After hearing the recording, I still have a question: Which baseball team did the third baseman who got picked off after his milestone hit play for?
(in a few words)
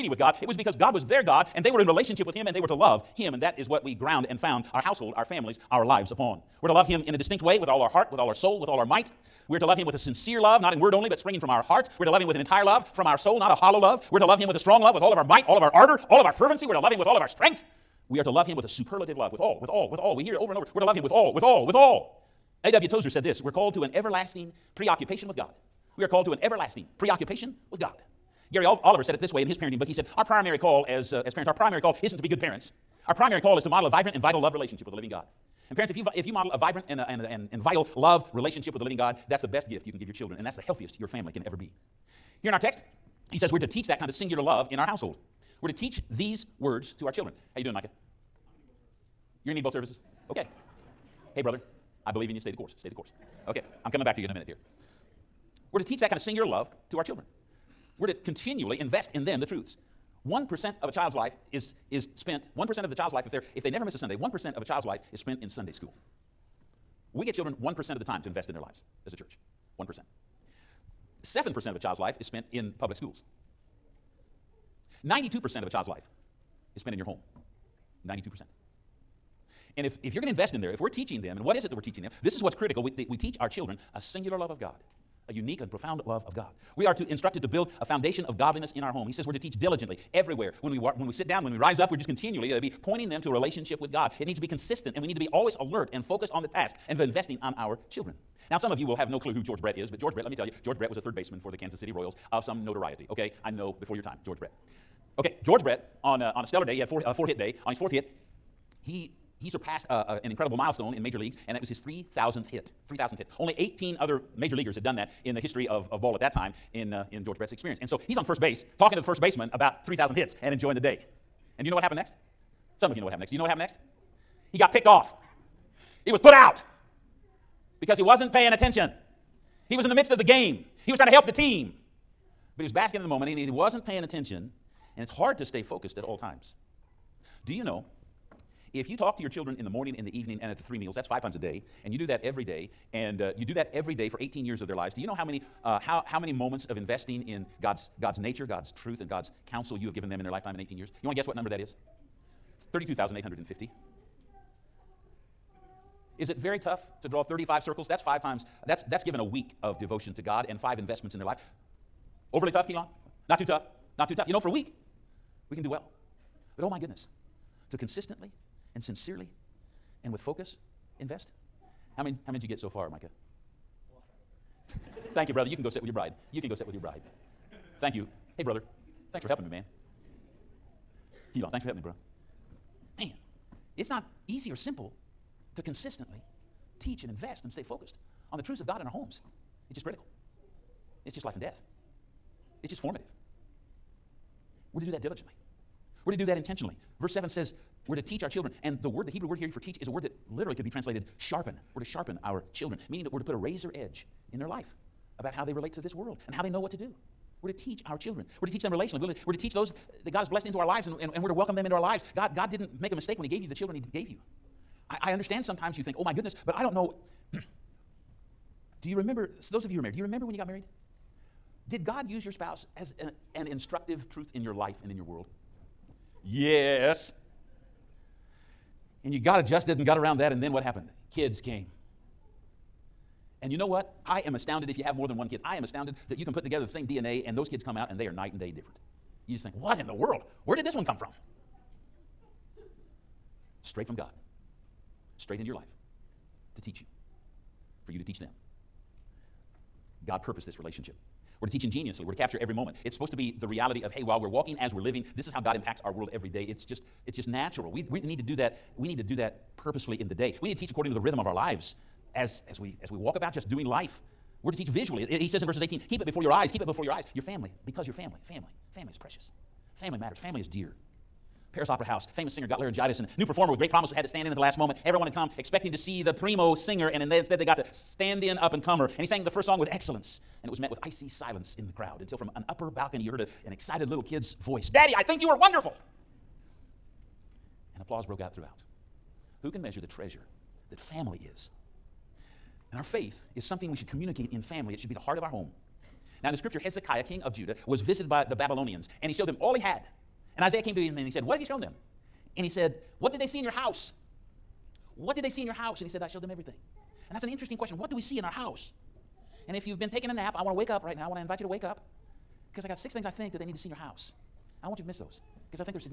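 Kansas City Royals.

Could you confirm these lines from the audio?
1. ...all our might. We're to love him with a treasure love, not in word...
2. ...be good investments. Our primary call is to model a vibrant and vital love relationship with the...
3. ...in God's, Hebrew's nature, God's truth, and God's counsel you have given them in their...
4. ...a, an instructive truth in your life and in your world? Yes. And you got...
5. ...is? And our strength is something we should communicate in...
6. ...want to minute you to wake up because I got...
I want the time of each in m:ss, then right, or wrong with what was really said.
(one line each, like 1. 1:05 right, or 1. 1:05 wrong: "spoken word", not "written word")
1. 0:08 wrong: "sincere", not "treasure"
2. 0:32 wrong: "parents", not "investments"
3. 2:27 wrong: "God", not "Hebrew"
4. 3:42 right
5. 4:51 wrong: "faith", not "strength"
6. 5:11 wrong: "invite", not "minute".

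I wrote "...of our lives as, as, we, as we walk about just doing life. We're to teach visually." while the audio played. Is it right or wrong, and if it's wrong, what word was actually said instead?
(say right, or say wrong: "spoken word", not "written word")
right.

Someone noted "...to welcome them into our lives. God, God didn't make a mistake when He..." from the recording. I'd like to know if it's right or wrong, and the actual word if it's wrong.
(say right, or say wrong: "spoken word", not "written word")
right.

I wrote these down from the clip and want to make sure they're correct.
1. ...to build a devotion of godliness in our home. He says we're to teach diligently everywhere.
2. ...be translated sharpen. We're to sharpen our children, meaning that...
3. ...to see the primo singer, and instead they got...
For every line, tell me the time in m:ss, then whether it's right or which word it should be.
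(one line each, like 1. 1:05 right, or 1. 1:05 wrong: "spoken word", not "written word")
1. 1:27 wrong: "foundation", not "devotion"
2. 3:20 right
3. 4:35 right.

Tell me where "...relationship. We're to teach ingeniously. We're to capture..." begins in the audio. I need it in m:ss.
4:10.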